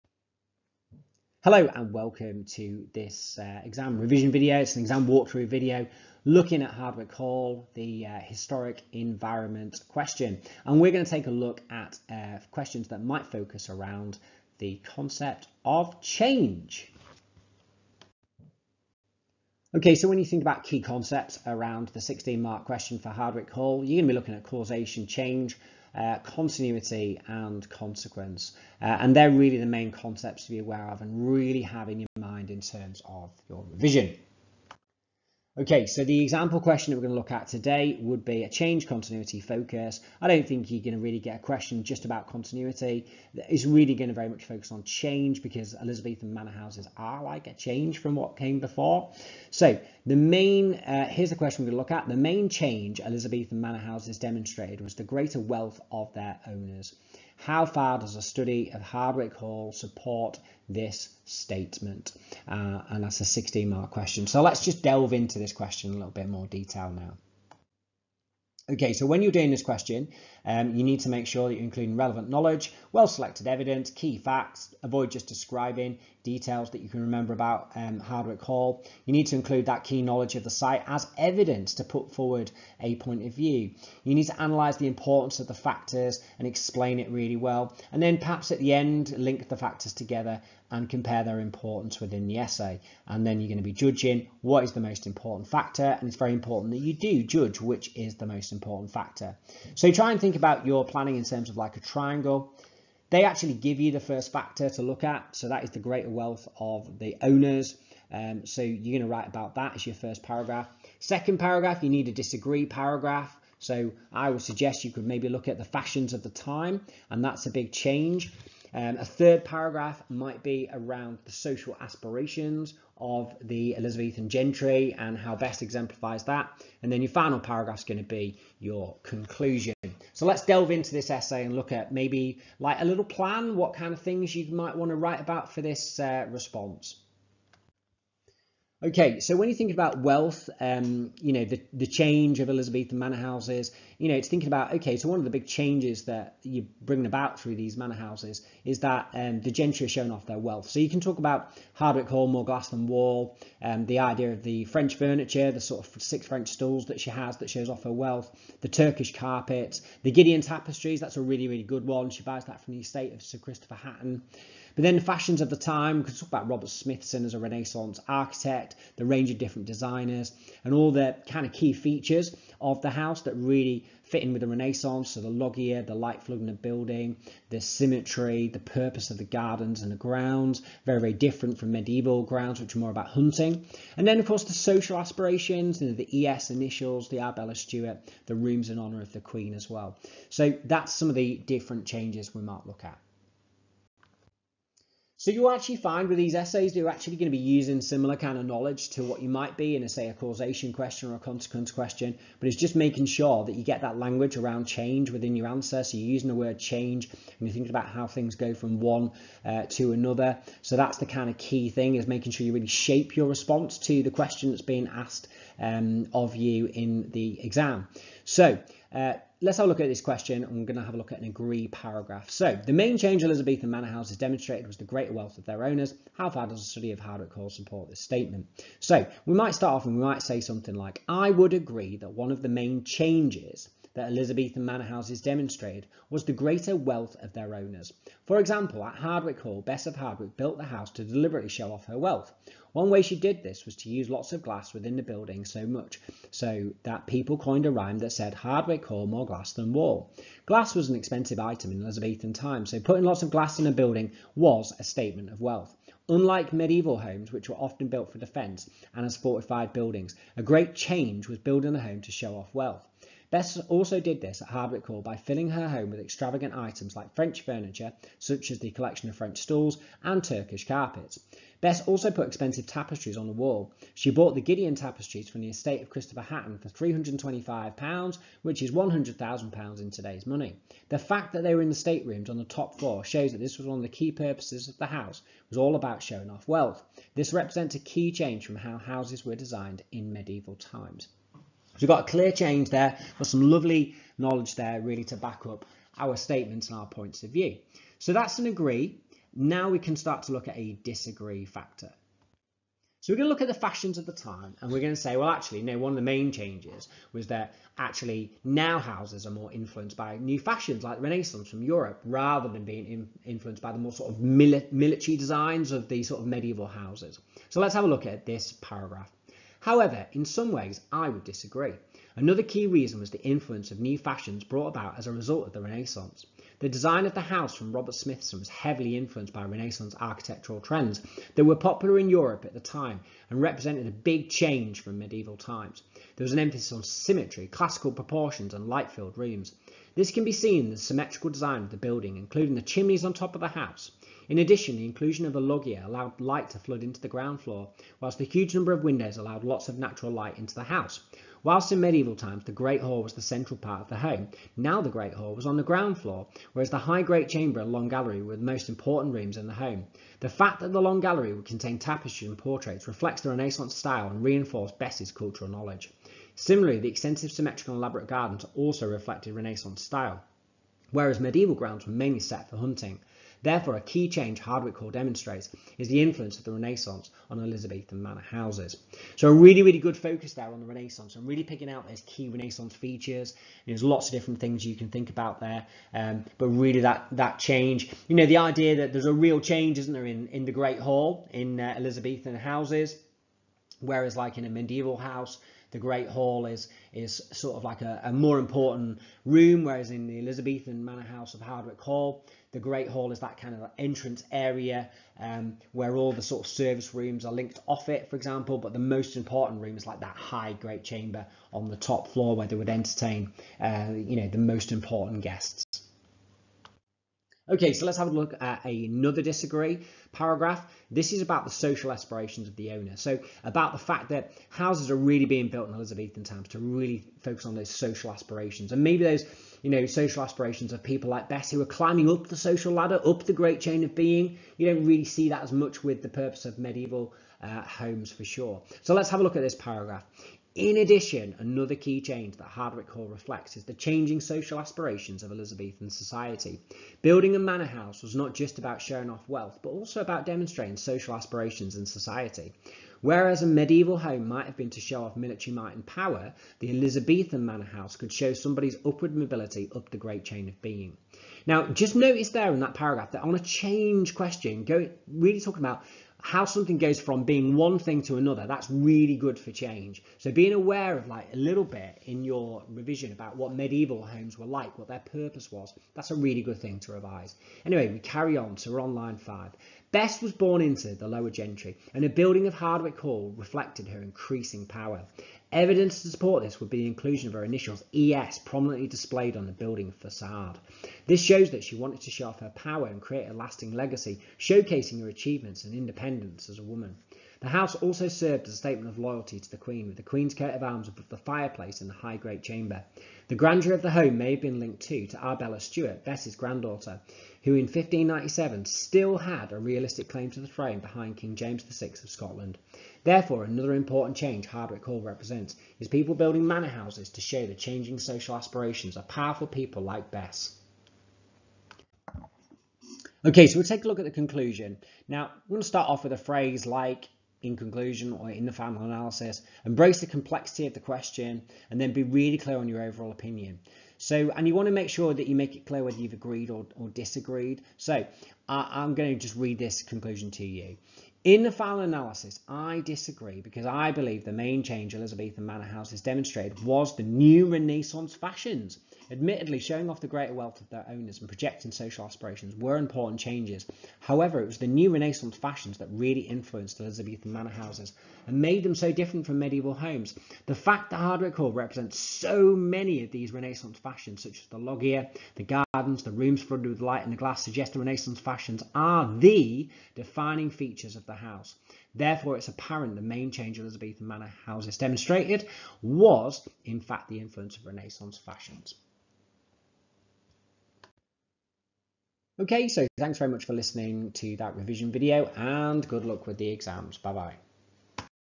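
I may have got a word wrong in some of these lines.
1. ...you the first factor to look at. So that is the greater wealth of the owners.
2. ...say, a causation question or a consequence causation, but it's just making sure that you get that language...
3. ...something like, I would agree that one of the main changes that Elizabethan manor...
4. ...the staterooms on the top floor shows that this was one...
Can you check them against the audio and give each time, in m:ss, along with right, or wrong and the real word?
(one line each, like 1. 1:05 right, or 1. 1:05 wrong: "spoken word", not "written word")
1. 1:43 right
2. 3:19 wrong: "question", not "causation"
3. 3:50 right
4. 4:41 right.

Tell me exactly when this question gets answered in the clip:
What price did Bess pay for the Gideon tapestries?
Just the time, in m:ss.
4:36.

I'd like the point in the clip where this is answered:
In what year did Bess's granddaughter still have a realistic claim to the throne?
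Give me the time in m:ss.
8:27.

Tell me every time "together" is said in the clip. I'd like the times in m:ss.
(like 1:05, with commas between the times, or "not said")
1:29.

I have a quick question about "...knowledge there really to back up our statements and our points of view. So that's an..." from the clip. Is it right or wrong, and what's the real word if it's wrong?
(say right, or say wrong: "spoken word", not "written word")
right.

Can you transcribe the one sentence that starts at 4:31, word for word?
Bess also put expensive tapestries on the wall.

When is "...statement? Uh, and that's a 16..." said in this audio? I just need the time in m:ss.
1:01.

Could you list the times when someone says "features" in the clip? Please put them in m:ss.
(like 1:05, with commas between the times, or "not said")
2:51, 6:22, 9:30.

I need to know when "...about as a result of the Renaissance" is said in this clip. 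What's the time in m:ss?
5:24.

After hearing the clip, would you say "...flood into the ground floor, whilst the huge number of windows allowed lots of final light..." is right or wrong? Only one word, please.
wrong.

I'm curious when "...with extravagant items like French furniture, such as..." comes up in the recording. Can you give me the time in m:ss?
4:25.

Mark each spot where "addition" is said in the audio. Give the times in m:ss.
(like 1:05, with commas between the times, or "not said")
5:44, 7:20.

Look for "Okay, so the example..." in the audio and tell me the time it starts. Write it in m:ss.
0:35.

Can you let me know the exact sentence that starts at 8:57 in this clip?
So, uh, I'm going to just read this conclusion to you.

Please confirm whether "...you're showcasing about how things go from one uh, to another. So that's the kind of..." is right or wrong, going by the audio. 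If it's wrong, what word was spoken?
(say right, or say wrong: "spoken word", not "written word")
wrong: "thinking", not "showcasing".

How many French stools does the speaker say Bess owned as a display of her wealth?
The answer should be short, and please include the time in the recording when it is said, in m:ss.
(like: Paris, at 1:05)
6, at 2:36.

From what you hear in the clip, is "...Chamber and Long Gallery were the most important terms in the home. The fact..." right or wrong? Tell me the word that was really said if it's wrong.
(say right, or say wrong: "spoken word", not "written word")
wrong: "rooms", not "terms".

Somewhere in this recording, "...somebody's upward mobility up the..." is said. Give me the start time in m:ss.
7:38.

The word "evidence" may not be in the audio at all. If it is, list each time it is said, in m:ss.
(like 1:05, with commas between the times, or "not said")
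1:13, 1:21, 8:05.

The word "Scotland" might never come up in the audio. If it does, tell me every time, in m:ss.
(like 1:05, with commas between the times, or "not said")
8:32.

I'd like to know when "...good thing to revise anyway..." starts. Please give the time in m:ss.
7:56.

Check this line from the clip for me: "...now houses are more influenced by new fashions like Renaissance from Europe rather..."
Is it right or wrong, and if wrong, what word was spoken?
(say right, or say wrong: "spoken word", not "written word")
right.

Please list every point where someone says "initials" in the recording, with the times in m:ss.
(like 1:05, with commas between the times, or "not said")
3:06, 8:07.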